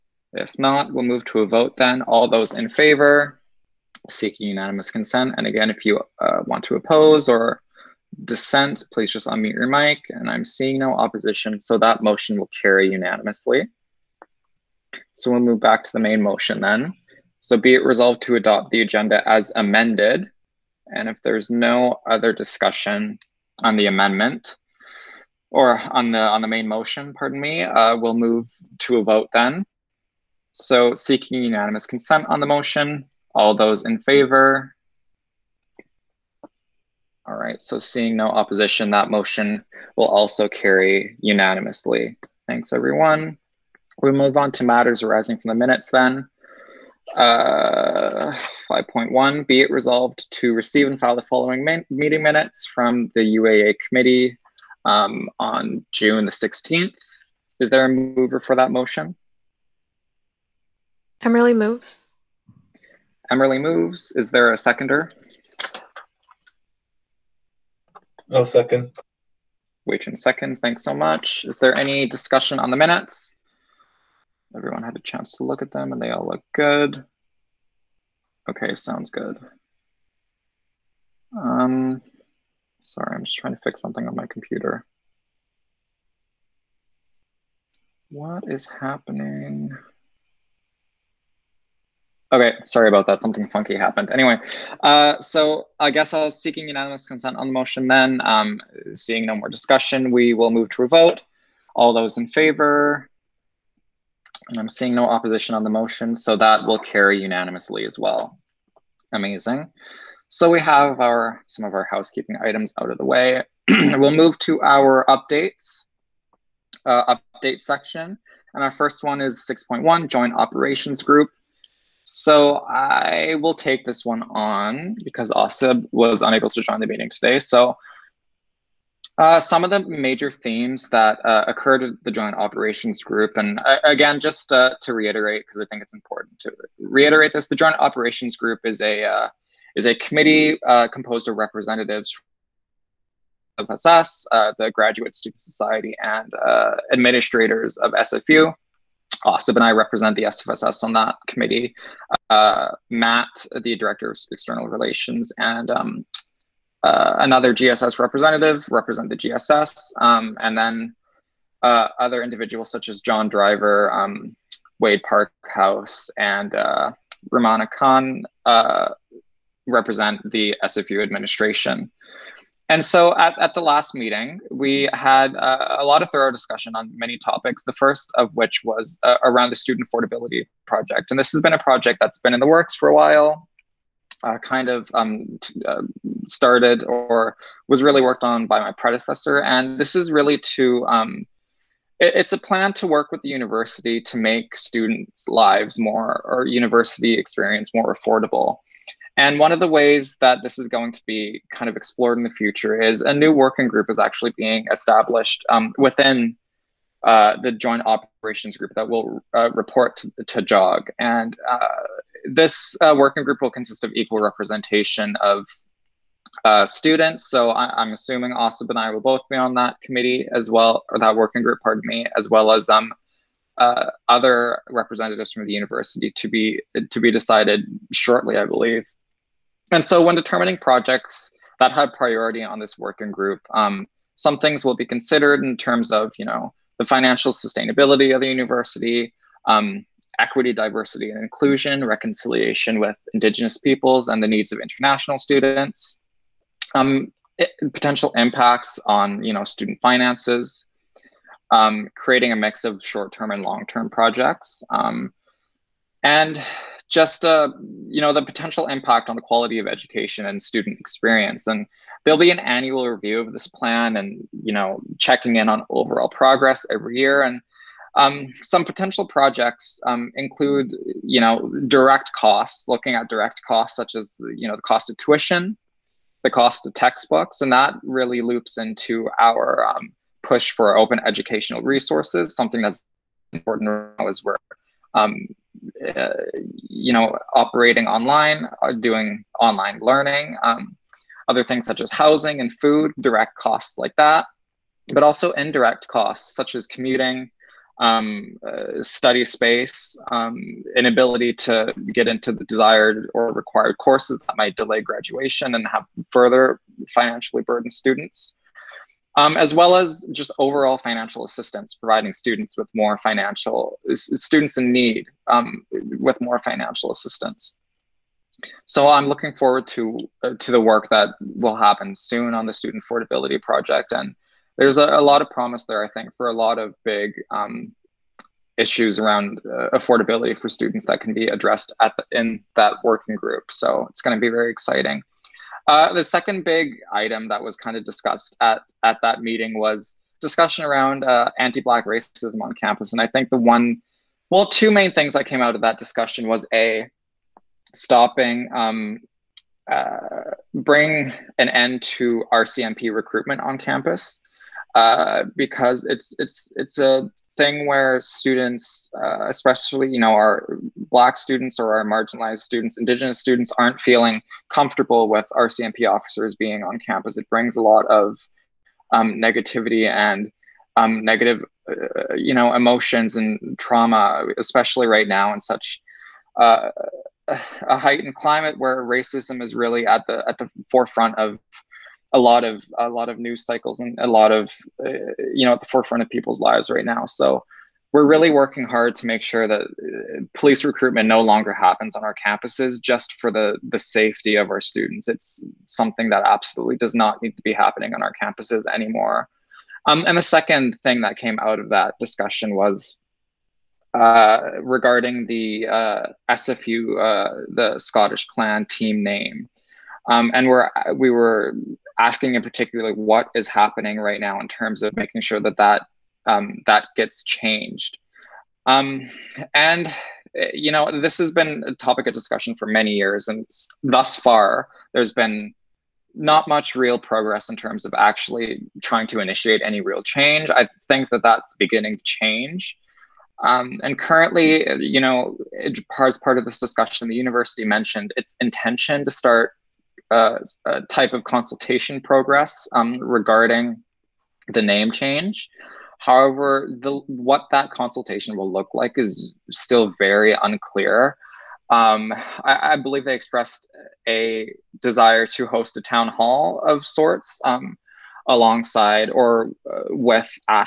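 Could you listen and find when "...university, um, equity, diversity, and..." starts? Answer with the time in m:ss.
3:58.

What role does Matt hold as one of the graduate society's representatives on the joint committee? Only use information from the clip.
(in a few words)
Director of External Relations.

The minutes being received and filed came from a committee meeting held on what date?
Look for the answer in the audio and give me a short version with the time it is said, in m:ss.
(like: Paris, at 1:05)
June 16, at 0:55.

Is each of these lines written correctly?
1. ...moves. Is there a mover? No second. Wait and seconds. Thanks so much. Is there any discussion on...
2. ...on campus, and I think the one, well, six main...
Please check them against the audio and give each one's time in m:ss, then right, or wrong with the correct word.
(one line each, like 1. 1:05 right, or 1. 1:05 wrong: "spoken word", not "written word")
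1. 1:03 wrong: "seconder", not "mover"
2. 5:42 wrong: "two", not "six".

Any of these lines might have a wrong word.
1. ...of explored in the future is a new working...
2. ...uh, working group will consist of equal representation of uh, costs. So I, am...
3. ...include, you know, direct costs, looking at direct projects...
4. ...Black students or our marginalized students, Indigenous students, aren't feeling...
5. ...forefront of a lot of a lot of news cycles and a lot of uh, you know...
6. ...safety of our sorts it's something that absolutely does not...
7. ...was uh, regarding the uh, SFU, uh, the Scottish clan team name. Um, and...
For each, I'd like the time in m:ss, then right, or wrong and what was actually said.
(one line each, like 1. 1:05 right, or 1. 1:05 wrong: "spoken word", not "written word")
1. 3:21 right
2. 3:32 wrong: "students", not "costs"
3. 4:30 wrong: "costs", not "projects"
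4. 6:00 right
5. 6:20 right
6. 6:33 wrong: "students", not "sorts"
7. 6:42 right.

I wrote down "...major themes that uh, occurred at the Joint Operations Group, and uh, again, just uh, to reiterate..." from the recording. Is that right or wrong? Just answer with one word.
right.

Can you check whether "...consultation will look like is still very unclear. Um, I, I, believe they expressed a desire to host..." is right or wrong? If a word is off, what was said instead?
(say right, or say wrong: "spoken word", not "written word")
right.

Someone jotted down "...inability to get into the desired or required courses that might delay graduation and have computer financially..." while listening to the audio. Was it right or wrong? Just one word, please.
wrong.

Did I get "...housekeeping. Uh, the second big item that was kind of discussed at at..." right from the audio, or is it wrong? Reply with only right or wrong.
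wrong.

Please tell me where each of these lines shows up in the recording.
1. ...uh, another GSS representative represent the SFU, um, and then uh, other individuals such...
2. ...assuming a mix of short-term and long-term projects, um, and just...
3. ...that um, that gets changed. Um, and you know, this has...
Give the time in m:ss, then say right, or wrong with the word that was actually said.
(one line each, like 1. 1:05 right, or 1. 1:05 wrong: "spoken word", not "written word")
1. 2:36 wrong: "GSS", not "SFU"
2. 4:11 wrong: "creating", not "assuming"
3. 6:55 right.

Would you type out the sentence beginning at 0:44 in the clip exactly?
We move on to matters arising from the minutes then.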